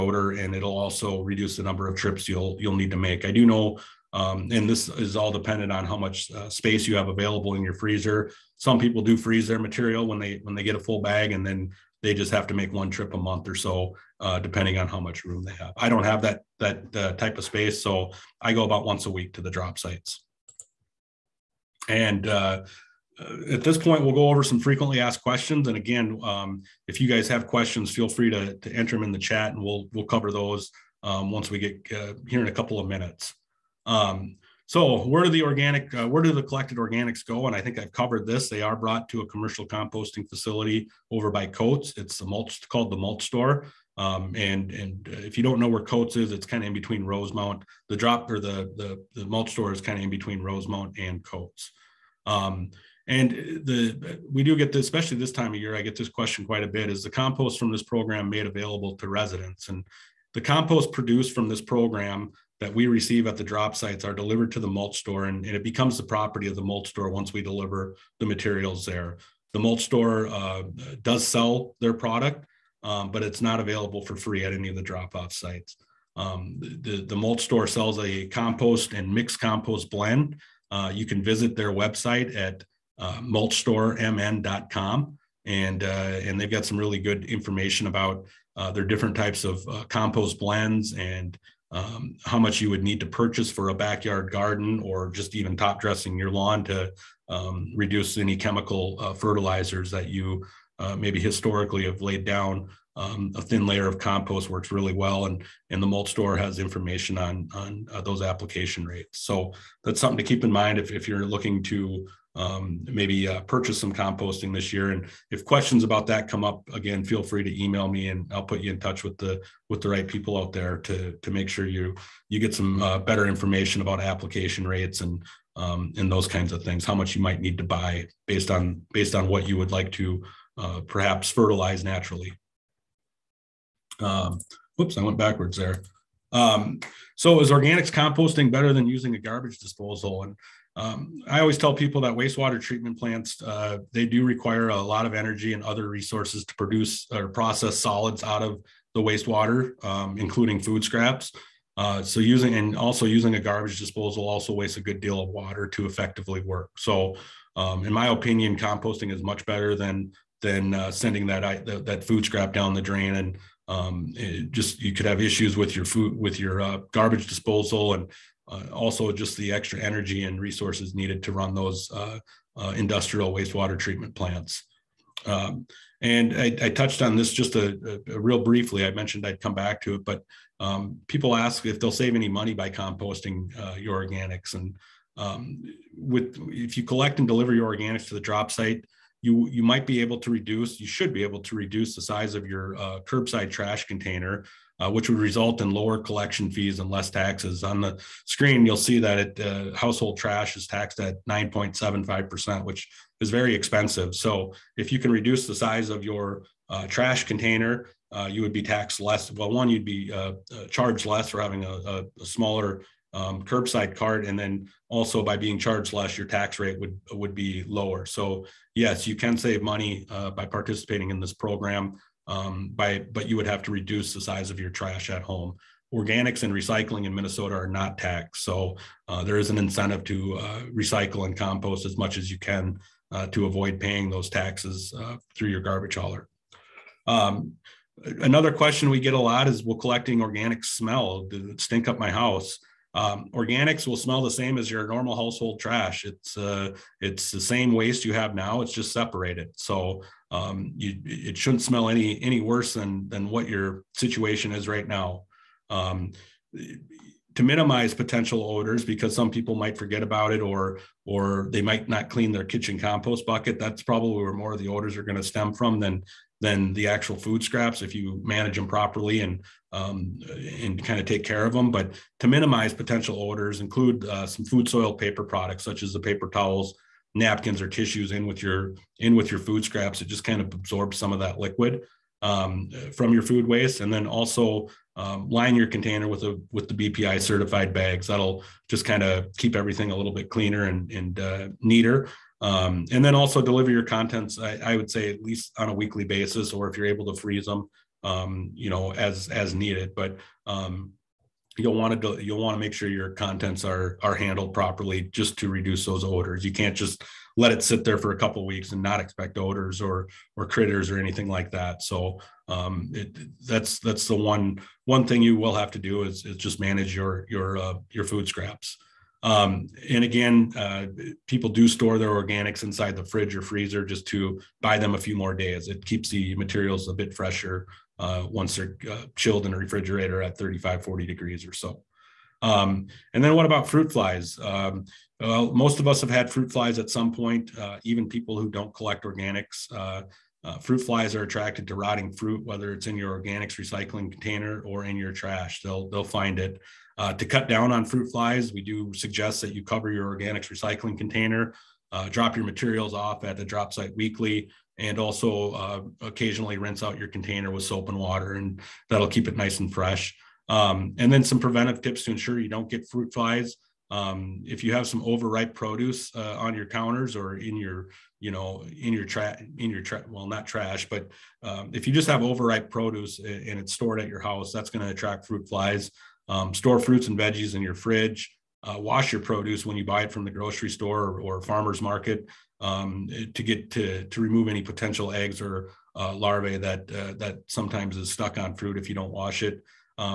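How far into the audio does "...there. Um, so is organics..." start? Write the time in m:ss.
2:15.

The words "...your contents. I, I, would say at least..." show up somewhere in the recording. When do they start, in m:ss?
4:53.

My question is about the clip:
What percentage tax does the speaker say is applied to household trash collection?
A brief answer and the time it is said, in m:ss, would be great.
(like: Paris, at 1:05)
9.75%, at 3:21.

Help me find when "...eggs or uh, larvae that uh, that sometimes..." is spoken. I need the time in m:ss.
6:25.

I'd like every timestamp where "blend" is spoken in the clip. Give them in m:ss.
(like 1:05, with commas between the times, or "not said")
1:19, 1:30.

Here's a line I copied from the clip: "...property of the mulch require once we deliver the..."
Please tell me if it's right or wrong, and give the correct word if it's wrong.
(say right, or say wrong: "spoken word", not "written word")
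wrong: "store", not "require".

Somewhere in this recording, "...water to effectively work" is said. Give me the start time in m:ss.
2:35.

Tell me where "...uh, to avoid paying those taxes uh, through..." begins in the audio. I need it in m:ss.
3:53.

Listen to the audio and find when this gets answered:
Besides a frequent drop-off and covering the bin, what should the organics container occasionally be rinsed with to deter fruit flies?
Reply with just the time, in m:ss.
5:57.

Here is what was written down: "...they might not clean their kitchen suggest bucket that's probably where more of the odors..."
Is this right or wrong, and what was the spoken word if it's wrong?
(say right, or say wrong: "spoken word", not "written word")
wrong: "compost", not "suggest".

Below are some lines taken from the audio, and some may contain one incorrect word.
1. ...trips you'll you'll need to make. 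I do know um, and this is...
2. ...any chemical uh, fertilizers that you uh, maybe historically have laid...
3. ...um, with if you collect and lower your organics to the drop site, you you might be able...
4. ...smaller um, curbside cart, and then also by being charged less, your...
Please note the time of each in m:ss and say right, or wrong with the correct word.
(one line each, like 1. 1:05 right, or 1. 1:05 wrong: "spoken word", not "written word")
1. 0:01 right
2. 1:38 right
3. 3:05 wrong: "deliver", not "lower"
4. 3:32 right.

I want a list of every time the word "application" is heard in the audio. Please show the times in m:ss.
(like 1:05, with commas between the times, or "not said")
1:48, 2:04.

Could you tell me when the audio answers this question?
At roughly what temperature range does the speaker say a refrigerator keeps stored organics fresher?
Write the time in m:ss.
5:30.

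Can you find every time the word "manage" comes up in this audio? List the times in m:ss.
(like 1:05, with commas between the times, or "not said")
4:28, 5:16.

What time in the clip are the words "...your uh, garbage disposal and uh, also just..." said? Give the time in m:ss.
2:46.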